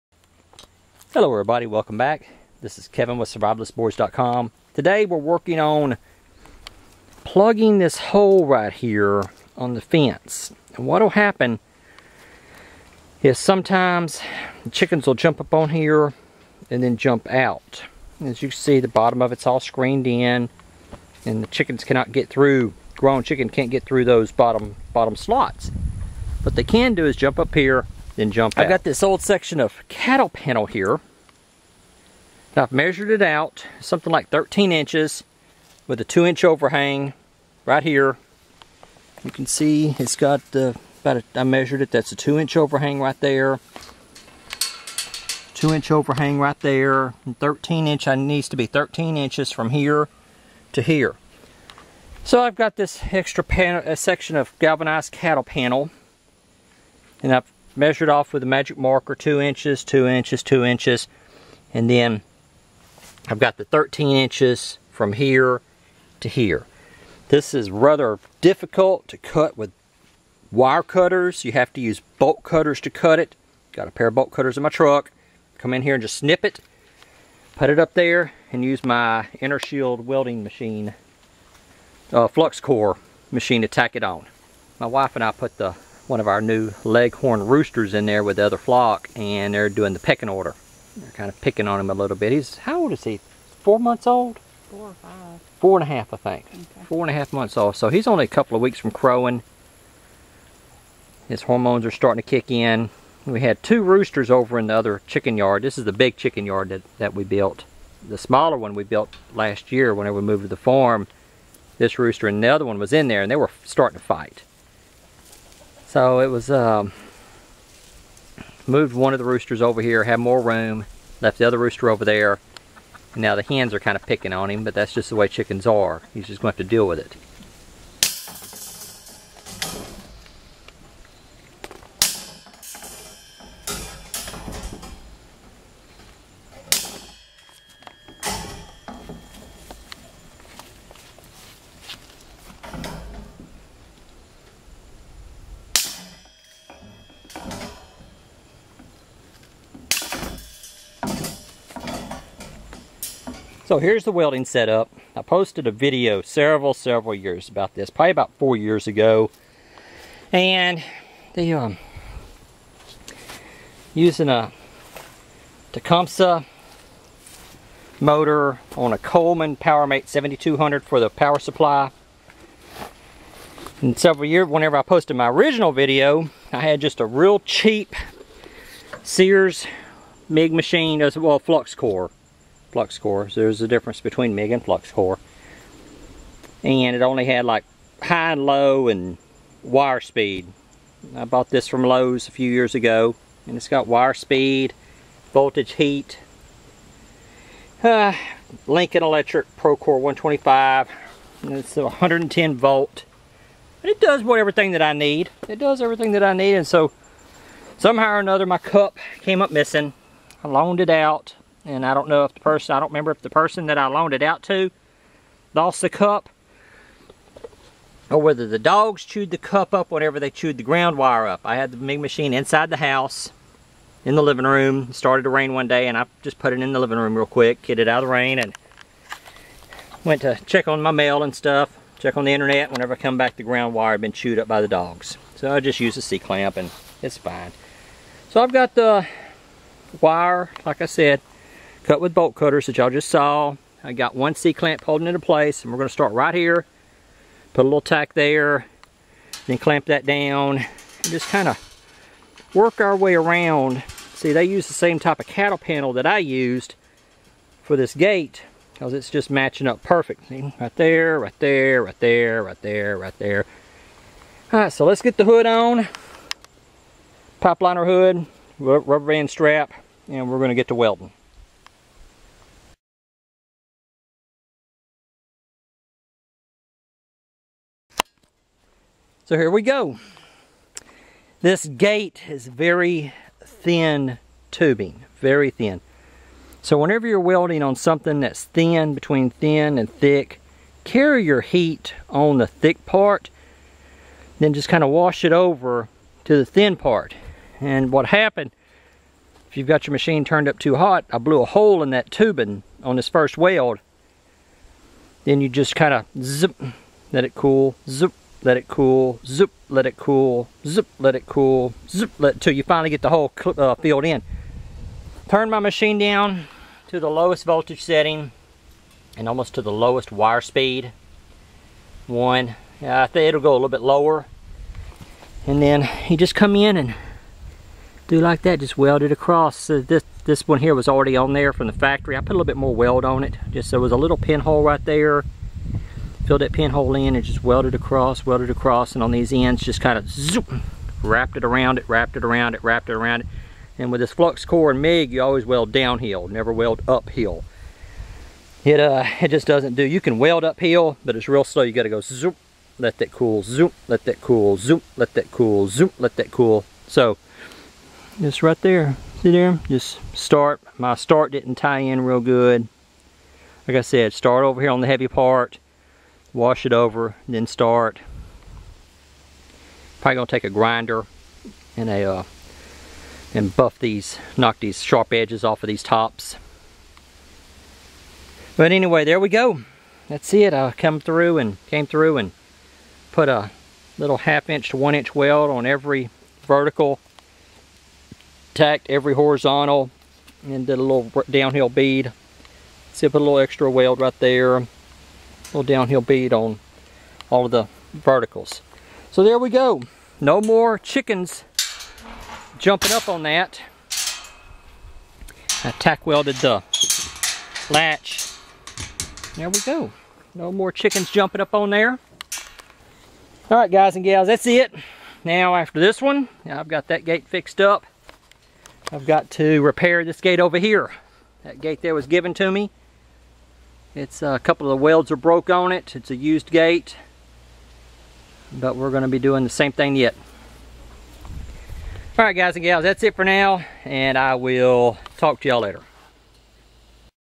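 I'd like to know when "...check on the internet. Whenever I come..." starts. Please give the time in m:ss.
3:51.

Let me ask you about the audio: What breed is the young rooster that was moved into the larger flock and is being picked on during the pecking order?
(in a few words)
Leghorn.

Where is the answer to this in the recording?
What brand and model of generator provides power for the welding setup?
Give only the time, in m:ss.
2:48.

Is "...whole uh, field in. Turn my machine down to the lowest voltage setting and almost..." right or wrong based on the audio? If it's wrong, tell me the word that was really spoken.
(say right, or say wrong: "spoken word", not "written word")
right.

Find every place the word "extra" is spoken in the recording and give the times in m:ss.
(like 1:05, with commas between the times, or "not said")
0:53, 6:33.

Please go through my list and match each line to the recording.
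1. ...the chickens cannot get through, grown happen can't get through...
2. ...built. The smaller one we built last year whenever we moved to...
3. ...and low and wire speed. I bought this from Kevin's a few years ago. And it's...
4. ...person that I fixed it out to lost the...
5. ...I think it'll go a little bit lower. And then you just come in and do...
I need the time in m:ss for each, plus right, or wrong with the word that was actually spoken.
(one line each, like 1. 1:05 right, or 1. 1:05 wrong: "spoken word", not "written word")
1. 0:21 wrong: "chicken", not "happen"
2. 1:47 right
3. 3:08 wrong: "Lowe", not "Kevin"
4. 3:33 wrong: "loaned", not "fixed"
5. 5:22 right.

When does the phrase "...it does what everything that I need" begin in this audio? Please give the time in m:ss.
3:23.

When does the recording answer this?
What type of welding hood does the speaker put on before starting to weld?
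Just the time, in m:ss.
4:27.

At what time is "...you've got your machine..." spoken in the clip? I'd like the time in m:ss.
4:59.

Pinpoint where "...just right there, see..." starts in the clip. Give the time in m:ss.
5:58.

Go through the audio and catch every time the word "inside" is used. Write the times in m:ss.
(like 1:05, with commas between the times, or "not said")
3:42.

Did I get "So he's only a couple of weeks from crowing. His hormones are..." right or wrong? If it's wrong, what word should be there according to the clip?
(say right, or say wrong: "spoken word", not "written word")
right.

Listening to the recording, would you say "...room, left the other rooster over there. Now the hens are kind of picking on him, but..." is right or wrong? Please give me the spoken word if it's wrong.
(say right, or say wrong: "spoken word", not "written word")
right.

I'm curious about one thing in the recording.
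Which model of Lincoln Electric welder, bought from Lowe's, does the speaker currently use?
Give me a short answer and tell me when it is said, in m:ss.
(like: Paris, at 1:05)
Procore 125, at 3:19.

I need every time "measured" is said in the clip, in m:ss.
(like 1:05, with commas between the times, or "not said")
0:32, 0:41, 0:57.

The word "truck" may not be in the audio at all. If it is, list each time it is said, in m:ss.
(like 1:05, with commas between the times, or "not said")
1:14.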